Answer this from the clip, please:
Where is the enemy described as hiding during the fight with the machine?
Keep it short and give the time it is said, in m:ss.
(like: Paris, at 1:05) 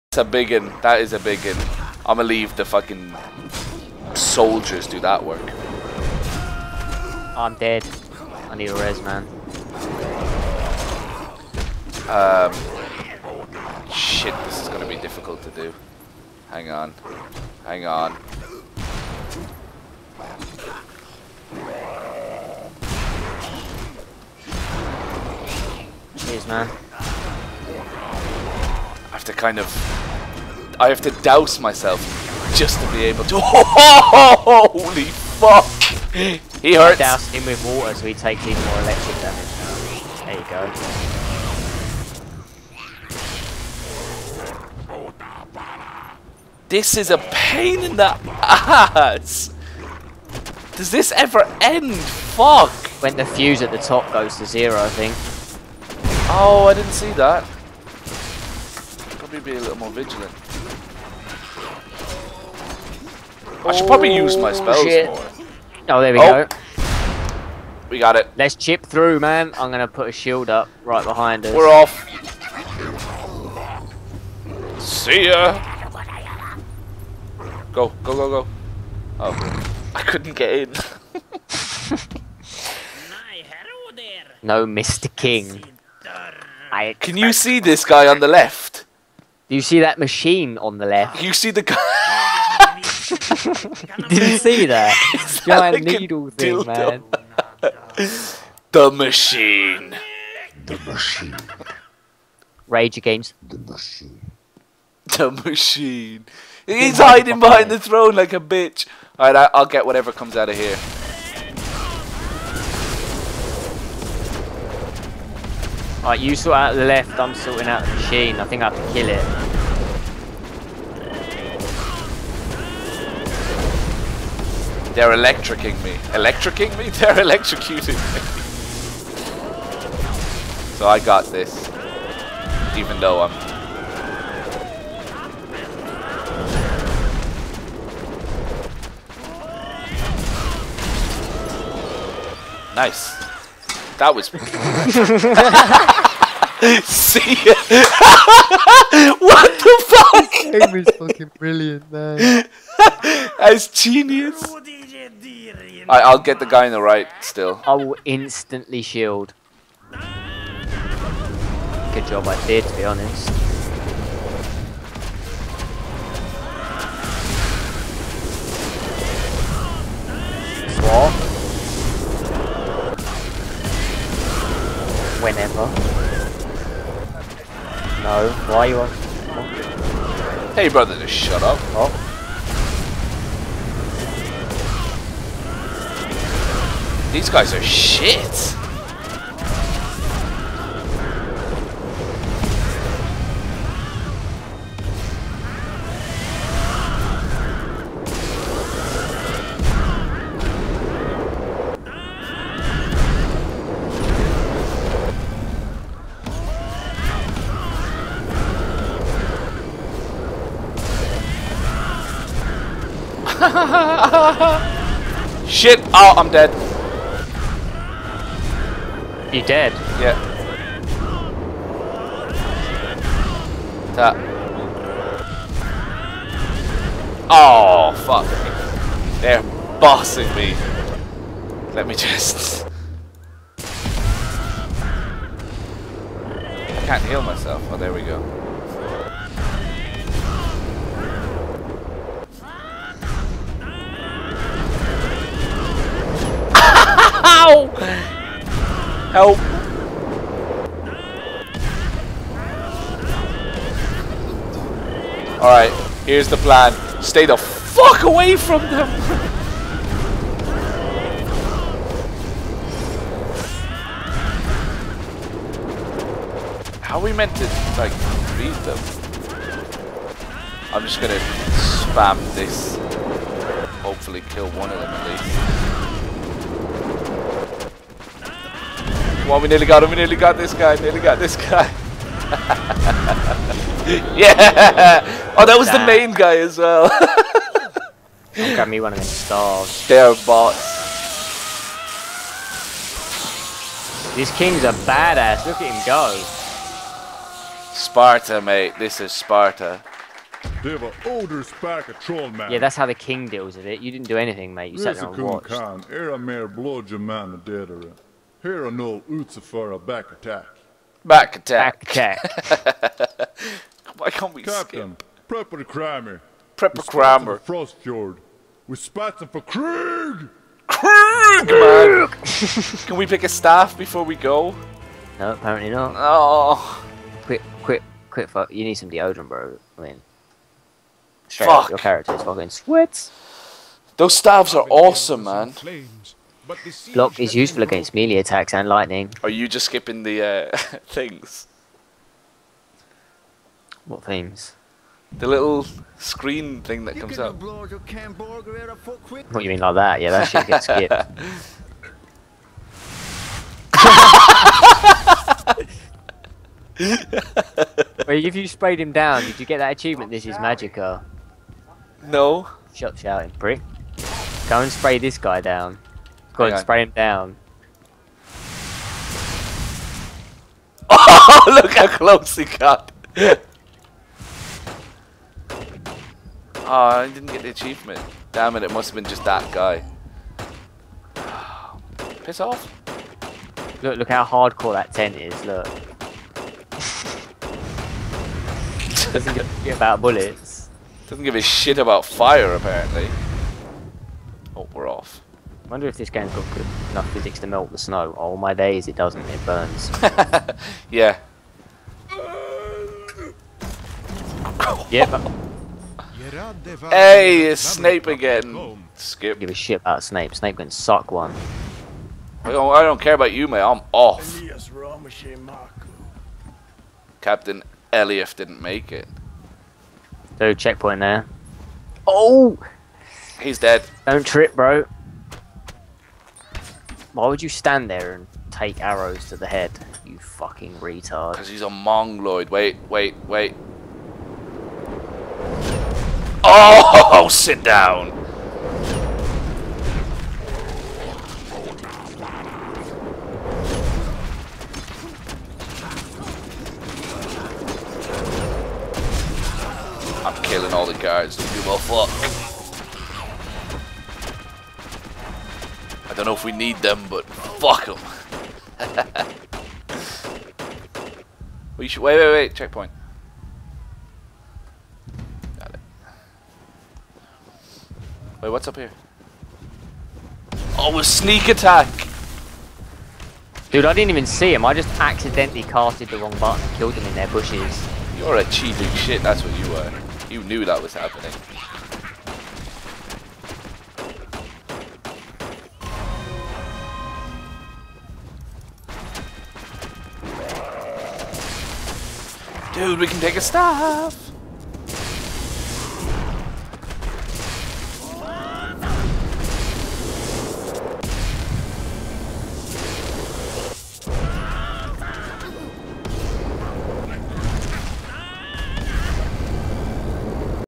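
Behind the throne, at 1:47.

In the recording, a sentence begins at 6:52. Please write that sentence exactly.
I don't, I don't care about you, mate.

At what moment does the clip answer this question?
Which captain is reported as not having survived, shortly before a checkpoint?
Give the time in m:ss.
6:57.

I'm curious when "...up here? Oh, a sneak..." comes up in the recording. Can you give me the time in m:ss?
7:48.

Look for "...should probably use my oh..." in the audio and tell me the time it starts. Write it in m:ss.
1:03.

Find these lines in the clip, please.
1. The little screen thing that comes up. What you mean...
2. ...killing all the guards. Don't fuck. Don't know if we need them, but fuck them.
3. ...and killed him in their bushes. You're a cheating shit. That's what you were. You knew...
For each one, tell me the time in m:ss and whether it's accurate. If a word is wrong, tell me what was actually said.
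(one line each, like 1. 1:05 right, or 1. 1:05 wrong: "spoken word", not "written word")
1. 5:45 right
2. 7:30 right
3. 7:56 right.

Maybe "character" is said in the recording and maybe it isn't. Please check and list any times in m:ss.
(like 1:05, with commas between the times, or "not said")
5:31.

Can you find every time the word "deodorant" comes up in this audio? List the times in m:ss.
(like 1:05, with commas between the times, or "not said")
5:28.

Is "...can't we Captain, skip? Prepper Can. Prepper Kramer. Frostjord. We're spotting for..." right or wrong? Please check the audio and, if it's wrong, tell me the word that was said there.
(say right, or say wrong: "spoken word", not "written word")
wrong: "Kramer", not "Can".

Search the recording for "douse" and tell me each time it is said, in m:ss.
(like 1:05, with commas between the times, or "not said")
0:31, 0:36.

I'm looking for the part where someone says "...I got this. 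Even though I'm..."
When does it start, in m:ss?
2:10.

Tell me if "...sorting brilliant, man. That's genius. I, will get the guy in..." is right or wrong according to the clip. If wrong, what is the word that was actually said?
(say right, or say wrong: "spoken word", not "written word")
wrong: "fucking", not "sorting".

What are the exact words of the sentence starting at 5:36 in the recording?
Block is useful against melee attacks and lightning.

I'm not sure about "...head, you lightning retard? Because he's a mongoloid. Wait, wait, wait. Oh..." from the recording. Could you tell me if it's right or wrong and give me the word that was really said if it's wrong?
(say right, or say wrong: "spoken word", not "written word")
wrong: "fucking", not "lightning".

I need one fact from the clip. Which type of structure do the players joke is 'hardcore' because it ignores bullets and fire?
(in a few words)
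Tent.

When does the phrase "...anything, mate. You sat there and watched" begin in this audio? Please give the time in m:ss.
5:04.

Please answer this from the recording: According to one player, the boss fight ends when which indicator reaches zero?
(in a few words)
The fuse.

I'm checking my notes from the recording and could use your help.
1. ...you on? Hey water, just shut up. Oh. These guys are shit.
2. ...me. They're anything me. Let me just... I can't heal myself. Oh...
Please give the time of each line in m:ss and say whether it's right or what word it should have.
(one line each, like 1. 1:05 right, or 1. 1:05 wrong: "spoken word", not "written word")
1. 2:58 wrong: "brother", not "water"
2. 3:48 wrong: "bossing", not "anything".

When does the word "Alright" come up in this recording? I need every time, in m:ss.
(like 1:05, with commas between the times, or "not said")
1:49, 1:56, 4:15.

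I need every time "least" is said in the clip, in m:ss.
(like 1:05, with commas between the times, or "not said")
4:35.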